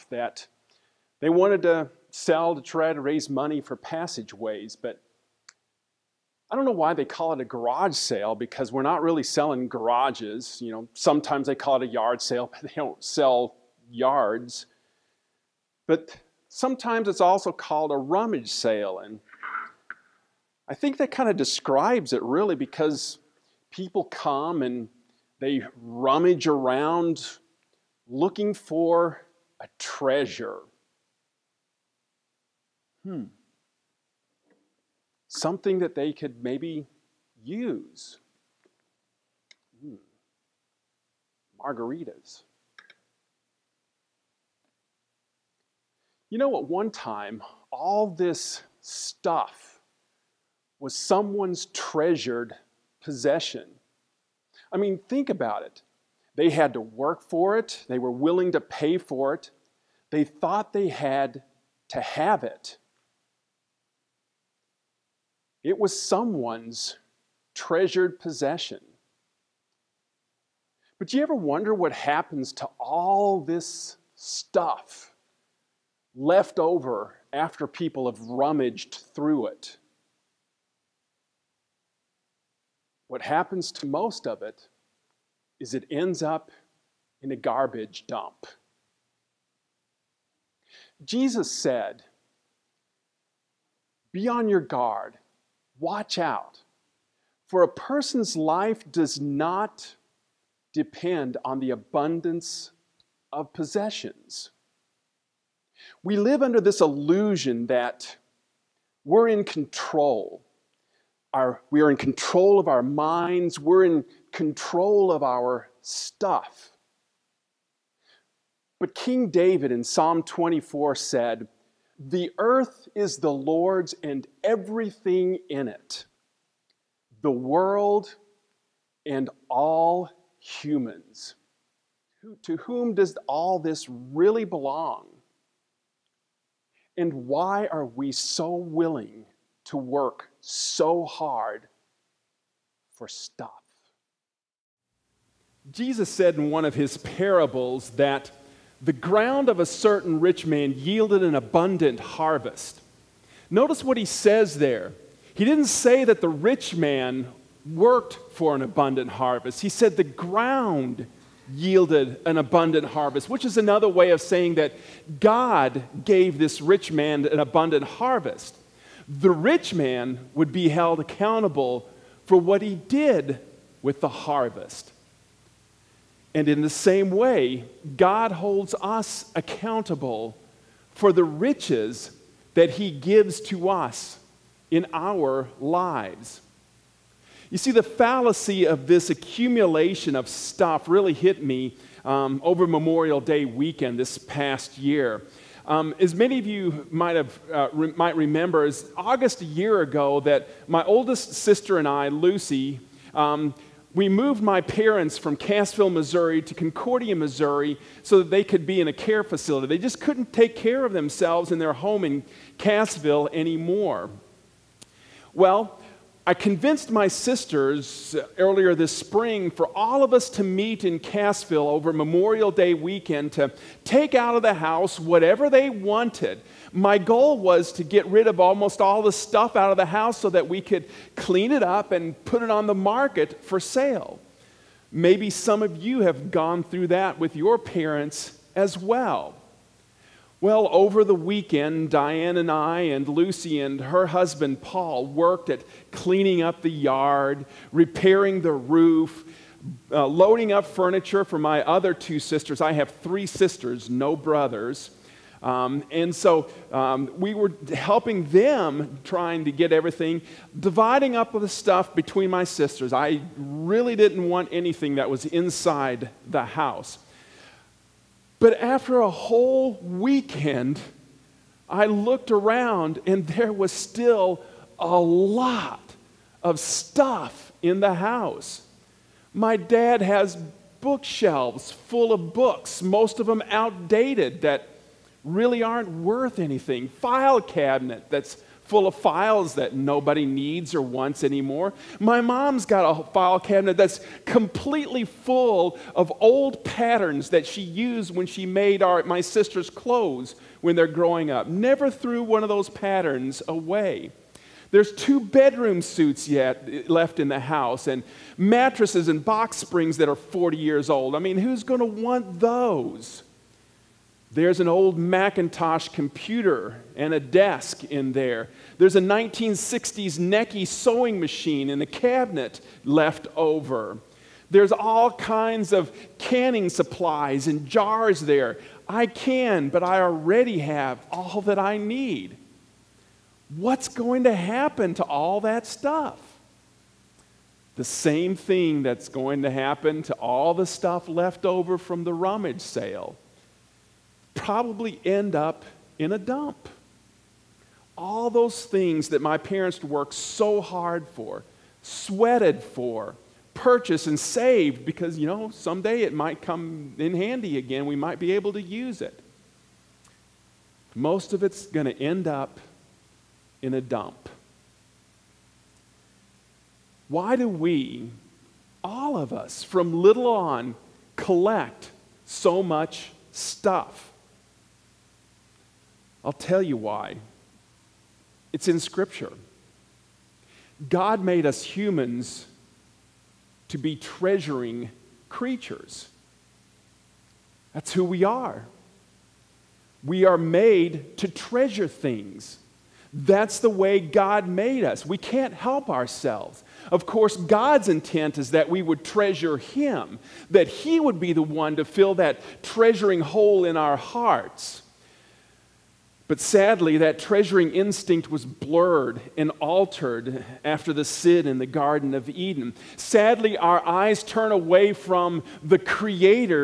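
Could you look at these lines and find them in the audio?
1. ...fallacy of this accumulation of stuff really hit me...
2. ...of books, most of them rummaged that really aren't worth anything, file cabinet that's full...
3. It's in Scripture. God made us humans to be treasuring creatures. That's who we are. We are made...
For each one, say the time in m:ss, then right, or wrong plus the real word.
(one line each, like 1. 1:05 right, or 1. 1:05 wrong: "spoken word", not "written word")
1. 3:07 right
2. 4:42 wrong: "outdated", not "rummaged"
3. 6:18 right.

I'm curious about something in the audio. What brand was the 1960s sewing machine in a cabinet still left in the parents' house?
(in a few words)
Necchi.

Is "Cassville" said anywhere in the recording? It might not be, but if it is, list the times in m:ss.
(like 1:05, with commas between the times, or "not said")
3:25, 3:32, 3:40.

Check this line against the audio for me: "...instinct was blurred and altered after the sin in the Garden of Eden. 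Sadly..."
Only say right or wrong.
right.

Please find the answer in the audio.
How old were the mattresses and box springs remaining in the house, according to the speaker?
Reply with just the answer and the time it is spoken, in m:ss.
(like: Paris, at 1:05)
40 years, at 5:10.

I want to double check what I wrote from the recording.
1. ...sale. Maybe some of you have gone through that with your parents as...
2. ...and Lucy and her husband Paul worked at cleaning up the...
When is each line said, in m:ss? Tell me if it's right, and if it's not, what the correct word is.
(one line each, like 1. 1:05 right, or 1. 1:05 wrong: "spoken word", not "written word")
1. 3:53 right
2. 4:02 right.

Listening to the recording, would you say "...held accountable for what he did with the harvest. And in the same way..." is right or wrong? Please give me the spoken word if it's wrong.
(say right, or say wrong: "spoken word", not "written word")
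right.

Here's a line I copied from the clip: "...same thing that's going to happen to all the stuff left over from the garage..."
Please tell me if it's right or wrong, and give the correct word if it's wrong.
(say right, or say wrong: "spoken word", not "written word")
wrong: "rummage", not "garage".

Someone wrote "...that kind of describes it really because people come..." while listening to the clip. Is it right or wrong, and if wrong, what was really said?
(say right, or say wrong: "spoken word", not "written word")
right.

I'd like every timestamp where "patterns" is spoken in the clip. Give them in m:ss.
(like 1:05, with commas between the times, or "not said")
4:56, 5:02.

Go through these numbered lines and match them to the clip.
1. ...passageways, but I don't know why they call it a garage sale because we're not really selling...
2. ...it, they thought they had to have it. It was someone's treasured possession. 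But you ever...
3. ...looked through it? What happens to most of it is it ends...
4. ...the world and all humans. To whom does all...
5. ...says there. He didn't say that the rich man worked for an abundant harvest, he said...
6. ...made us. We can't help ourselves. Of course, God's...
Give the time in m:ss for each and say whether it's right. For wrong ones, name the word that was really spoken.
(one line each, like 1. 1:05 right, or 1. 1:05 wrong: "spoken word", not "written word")
1. 0:03 right
2. 0:59 right
3. 1:18 wrong: "rummaged", not "looked"
4. 2:07 right
5. 2:34 right
6. 6:34 right.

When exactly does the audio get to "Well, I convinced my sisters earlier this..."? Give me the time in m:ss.
3:35.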